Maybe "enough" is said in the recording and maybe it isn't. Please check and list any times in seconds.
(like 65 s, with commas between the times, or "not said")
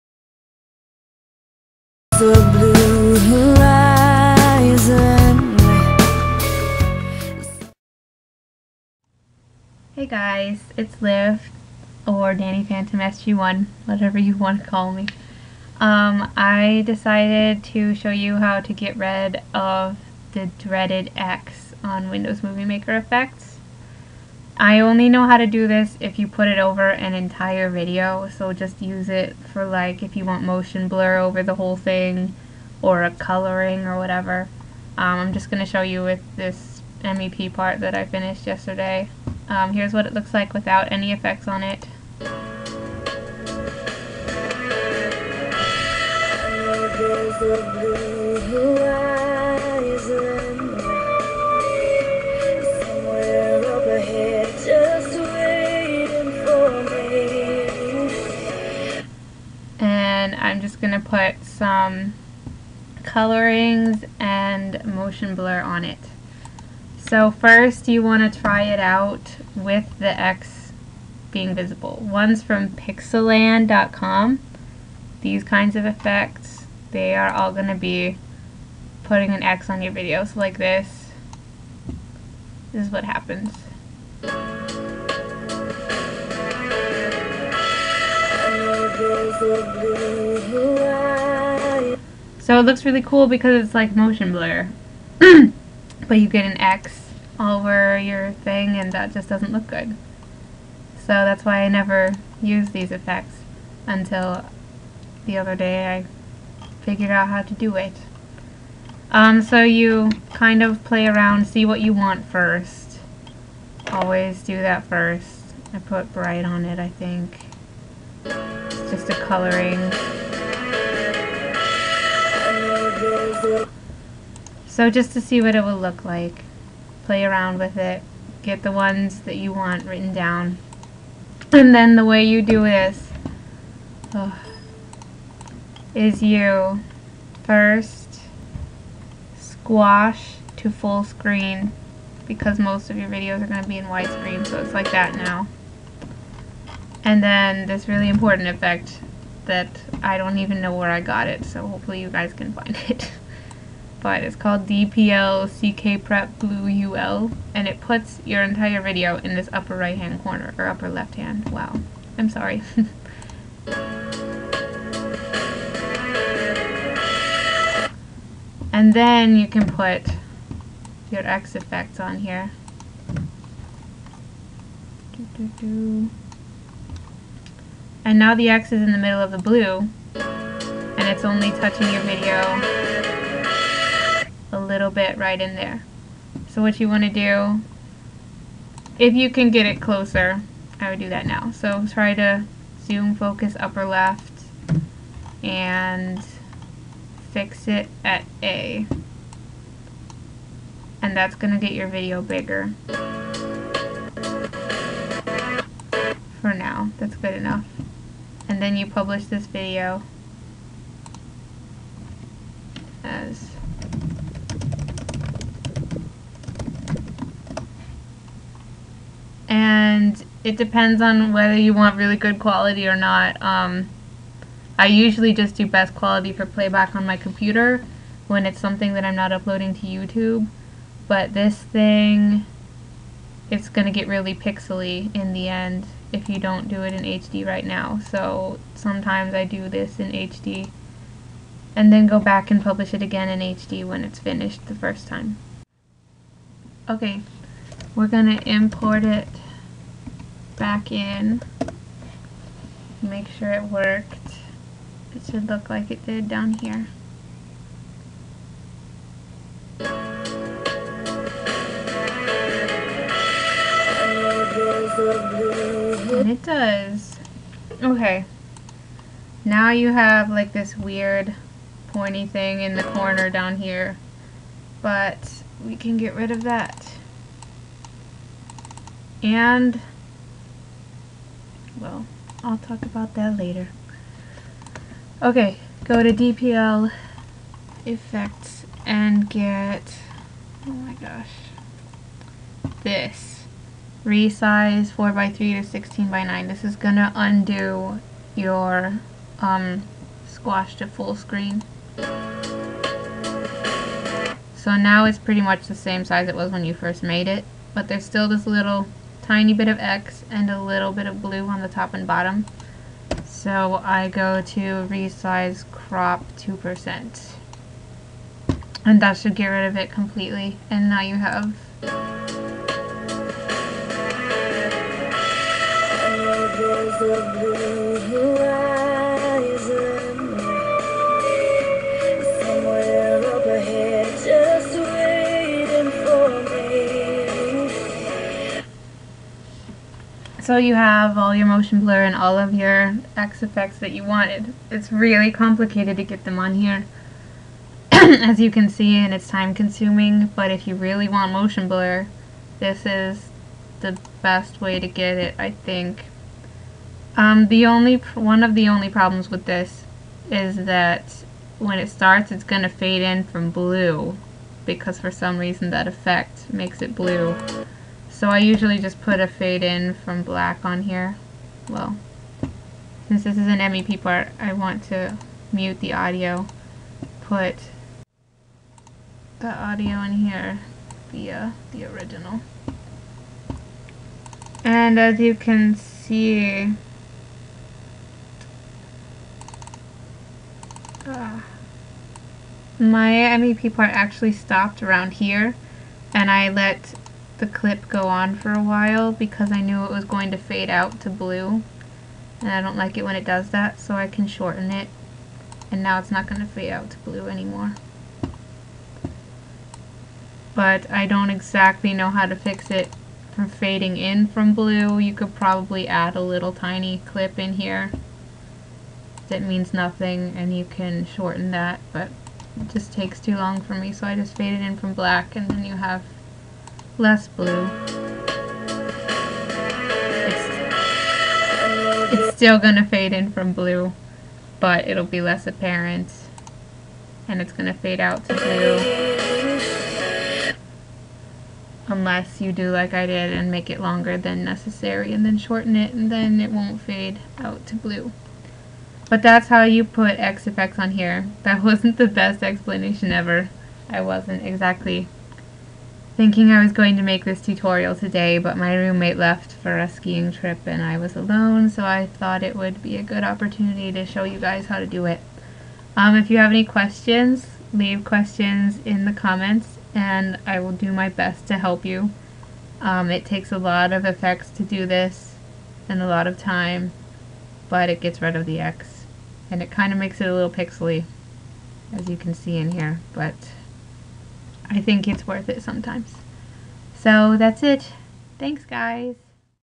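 207 s.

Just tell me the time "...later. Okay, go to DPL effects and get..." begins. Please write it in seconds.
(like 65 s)
283 s.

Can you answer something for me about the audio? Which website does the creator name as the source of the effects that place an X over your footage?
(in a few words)
Pixelan.com.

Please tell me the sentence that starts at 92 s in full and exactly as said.
So it looks really cool because it's like motion blur.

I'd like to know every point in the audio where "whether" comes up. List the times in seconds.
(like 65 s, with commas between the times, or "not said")
221 s.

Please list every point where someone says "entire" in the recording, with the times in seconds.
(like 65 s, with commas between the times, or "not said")
27 s, 158 s.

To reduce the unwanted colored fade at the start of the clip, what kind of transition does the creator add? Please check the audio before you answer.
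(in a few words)
fade in from black.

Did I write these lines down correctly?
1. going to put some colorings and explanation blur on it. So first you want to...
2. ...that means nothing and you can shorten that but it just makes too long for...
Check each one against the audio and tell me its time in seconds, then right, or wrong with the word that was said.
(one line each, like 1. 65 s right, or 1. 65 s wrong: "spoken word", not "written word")
1. 60 s wrong: "motion", not "explanation"
2. 419 s wrong: "takes", not "makes".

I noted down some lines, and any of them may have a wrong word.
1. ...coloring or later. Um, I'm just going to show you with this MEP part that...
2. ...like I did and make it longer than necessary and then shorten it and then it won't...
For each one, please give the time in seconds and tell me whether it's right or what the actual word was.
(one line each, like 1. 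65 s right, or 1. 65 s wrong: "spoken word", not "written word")
1. 33 s wrong: "whatever", not "later"
2. 442 s right.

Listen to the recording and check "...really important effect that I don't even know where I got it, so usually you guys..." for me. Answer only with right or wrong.
wrong.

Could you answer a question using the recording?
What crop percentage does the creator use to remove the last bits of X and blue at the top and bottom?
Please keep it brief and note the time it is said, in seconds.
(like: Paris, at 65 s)
2%, at 316 s.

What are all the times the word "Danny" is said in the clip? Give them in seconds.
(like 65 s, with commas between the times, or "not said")
12 s.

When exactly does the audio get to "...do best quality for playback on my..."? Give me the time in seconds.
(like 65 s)
225 s.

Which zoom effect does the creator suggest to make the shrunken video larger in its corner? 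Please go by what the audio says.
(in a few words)
zoom focus upper left.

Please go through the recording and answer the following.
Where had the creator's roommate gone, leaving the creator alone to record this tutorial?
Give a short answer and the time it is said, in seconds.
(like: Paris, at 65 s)
a skiing trip, at 459 s.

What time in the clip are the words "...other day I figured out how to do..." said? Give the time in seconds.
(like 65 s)
105 s.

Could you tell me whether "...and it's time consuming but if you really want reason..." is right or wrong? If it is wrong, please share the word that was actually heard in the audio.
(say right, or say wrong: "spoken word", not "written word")
wrong: "motion", not "reason".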